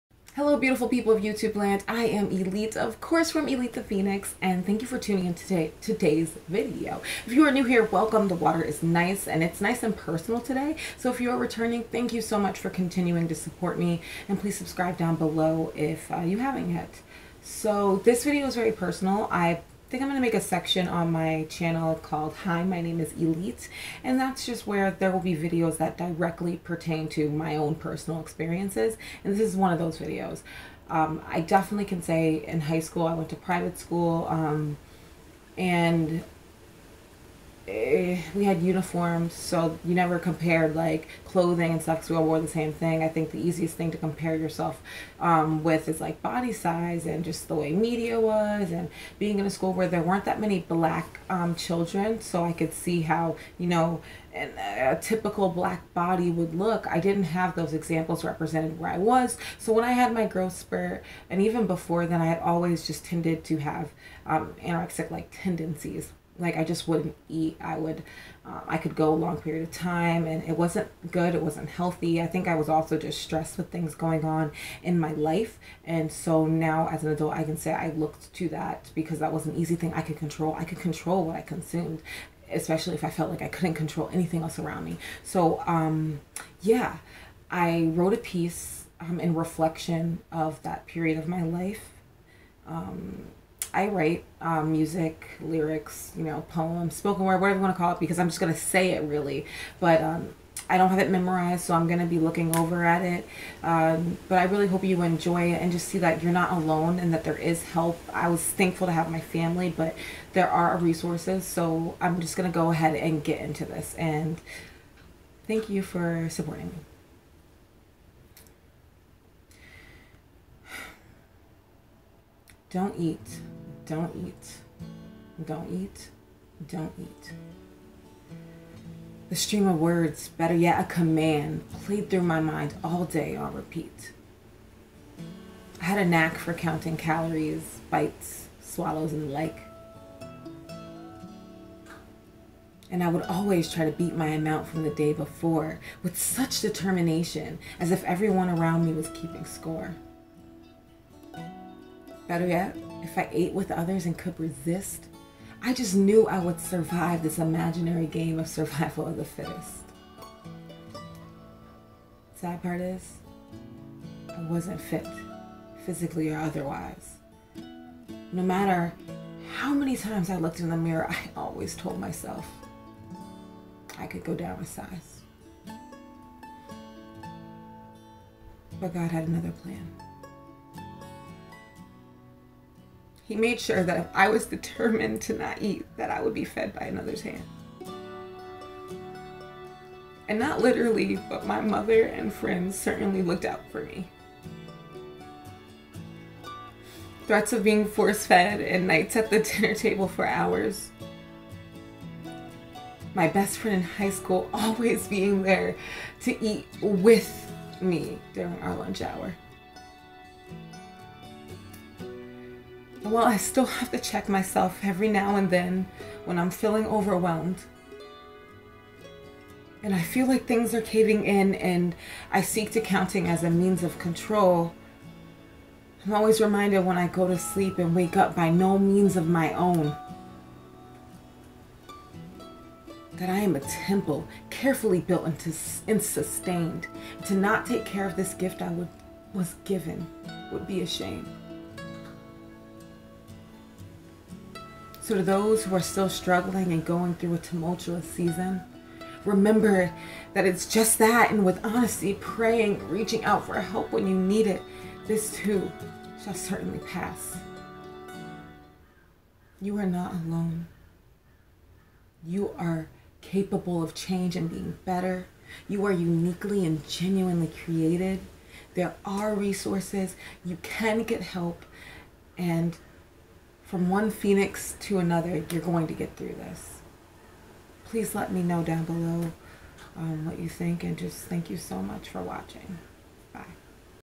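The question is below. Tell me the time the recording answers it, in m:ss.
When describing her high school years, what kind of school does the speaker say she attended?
0:33.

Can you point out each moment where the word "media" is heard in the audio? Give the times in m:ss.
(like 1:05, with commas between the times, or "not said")
0:47.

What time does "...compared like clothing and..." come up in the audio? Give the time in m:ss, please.
0:40.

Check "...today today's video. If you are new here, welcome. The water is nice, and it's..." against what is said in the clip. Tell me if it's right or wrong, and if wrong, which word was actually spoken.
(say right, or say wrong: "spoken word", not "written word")
right.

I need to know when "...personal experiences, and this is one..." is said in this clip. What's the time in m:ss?
0:27.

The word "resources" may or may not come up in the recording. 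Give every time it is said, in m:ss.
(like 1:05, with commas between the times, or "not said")
1:50, 4:29.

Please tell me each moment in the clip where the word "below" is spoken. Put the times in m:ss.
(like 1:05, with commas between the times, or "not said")
0:15, 4:38.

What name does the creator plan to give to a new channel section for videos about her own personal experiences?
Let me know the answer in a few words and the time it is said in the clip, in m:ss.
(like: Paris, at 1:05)
Hi, my name is Elite, at 0:22.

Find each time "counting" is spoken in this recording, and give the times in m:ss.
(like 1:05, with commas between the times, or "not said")
2:16, 3:42.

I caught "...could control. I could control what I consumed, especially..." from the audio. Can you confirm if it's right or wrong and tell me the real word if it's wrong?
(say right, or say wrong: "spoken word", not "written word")
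right.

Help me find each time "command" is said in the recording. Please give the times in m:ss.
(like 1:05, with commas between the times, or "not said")
2:10.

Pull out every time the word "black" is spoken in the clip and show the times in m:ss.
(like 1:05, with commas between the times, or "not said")
0:50, 0:55.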